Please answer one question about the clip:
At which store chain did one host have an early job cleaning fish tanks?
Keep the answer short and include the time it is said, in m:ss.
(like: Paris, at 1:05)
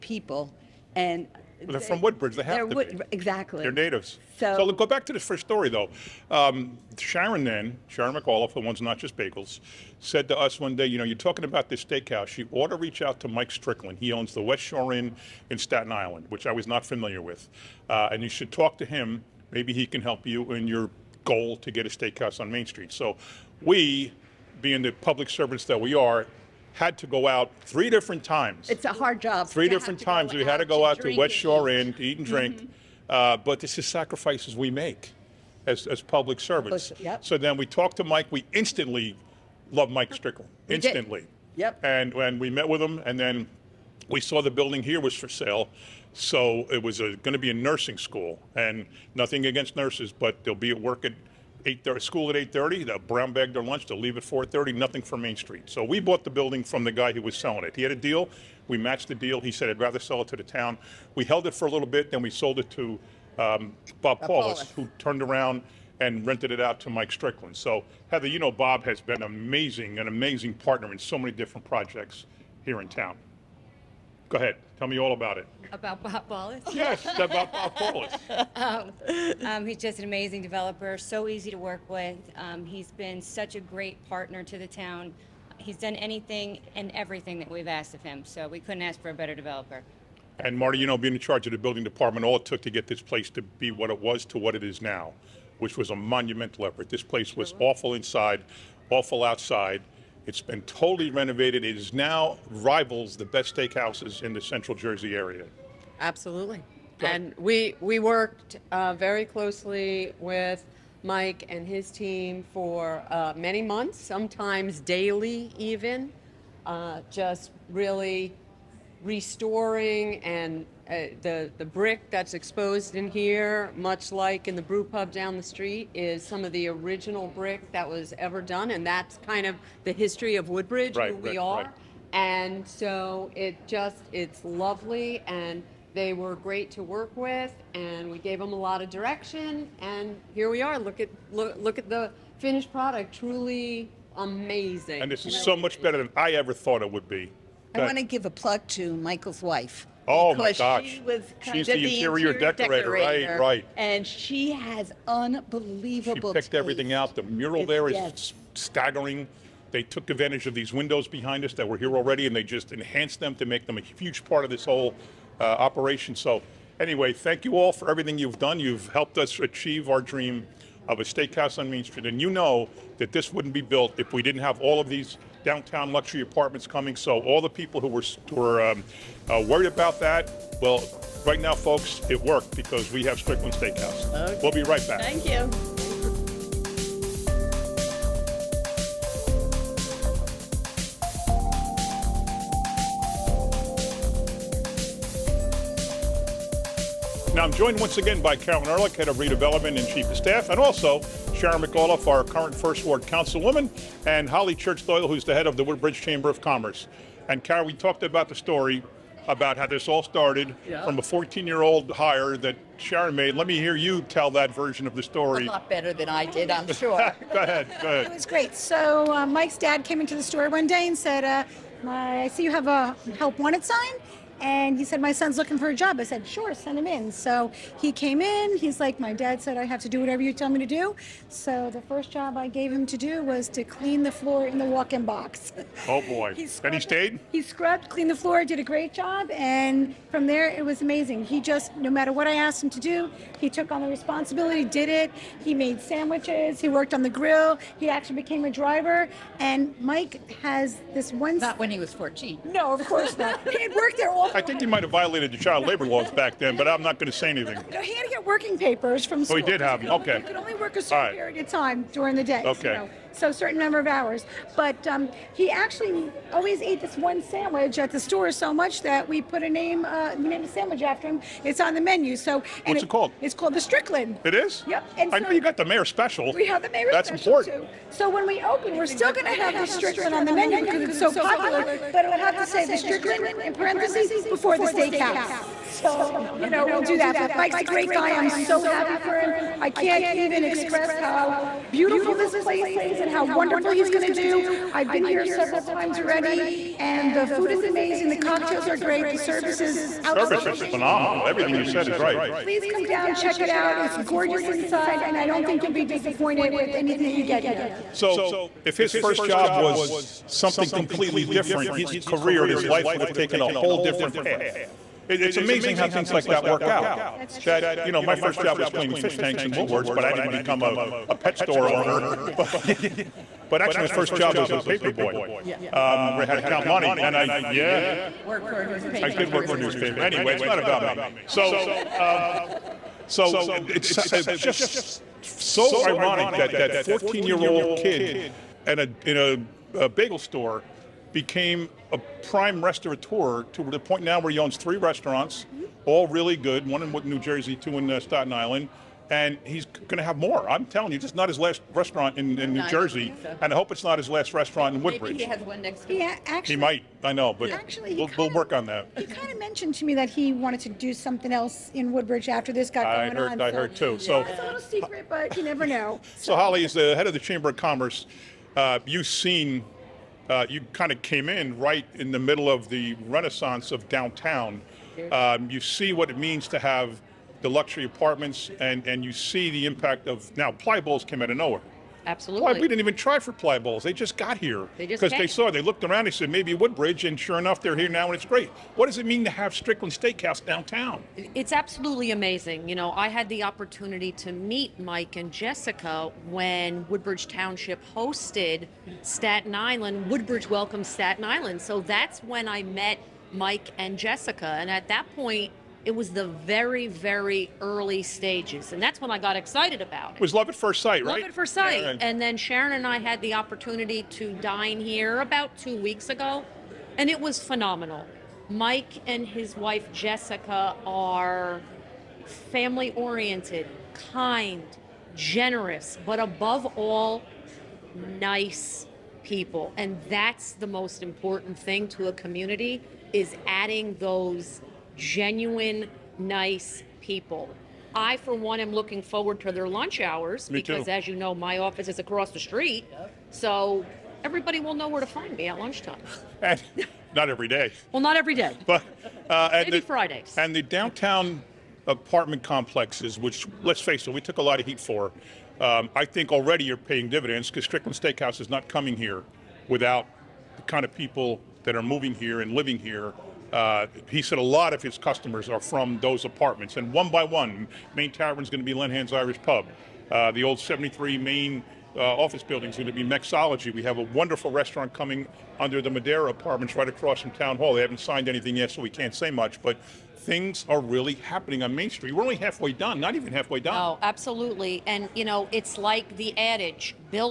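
Woolworths, at 5:19.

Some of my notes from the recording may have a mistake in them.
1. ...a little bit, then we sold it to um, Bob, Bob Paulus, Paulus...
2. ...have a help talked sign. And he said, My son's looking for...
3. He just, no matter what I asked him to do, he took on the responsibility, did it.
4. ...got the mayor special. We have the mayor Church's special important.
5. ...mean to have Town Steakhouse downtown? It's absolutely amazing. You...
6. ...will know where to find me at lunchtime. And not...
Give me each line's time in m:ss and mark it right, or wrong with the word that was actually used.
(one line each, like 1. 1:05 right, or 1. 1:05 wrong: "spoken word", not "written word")
1. 1:01 right
2. 3:42 wrong: "wanted", not "talked"
3. 4:01 right
4. 4:35 wrong: "That", not "Church"
5. 6:29 wrong: "Strickland", not "Town"
6. 7:24 right.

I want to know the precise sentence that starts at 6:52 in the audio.
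And then Sharon and I had the opportunity to dine here about two weeks ago, and it was phenomenal.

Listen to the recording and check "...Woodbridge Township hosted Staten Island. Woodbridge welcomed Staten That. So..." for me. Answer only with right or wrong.
wrong.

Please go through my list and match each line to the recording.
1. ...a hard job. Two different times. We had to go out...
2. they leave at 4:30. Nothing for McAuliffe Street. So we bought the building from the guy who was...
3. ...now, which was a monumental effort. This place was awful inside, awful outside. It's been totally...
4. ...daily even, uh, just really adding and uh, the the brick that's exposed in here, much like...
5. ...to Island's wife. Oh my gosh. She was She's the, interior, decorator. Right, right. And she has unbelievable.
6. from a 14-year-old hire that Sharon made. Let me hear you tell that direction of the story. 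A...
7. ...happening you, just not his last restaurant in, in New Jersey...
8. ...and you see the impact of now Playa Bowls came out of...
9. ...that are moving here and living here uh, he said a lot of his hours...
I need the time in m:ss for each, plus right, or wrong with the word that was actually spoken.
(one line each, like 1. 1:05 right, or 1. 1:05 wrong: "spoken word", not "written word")
1. 0:28 wrong: "Three", not "Two"
2. 0:53 wrong: "Main", not "McAuliffe"
3. 1:34 right
4. 1:54 wrong: "restoring", not "adding"
5. 2:28 wrong: "Michael", not "Island"
6. 3:30 wrong: "version", not "direction"
7. 5:50 wrong: "telling", not "happening"
8. 6:18 right
9. 7:41 wrong: "customers", not "hours".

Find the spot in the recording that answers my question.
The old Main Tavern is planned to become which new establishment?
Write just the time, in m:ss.
7:48.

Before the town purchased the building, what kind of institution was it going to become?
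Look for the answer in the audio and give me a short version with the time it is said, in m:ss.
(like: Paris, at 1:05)
A nursing school, at 0:47.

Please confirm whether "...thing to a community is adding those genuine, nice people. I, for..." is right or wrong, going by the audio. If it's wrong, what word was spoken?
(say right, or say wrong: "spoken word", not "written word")
right.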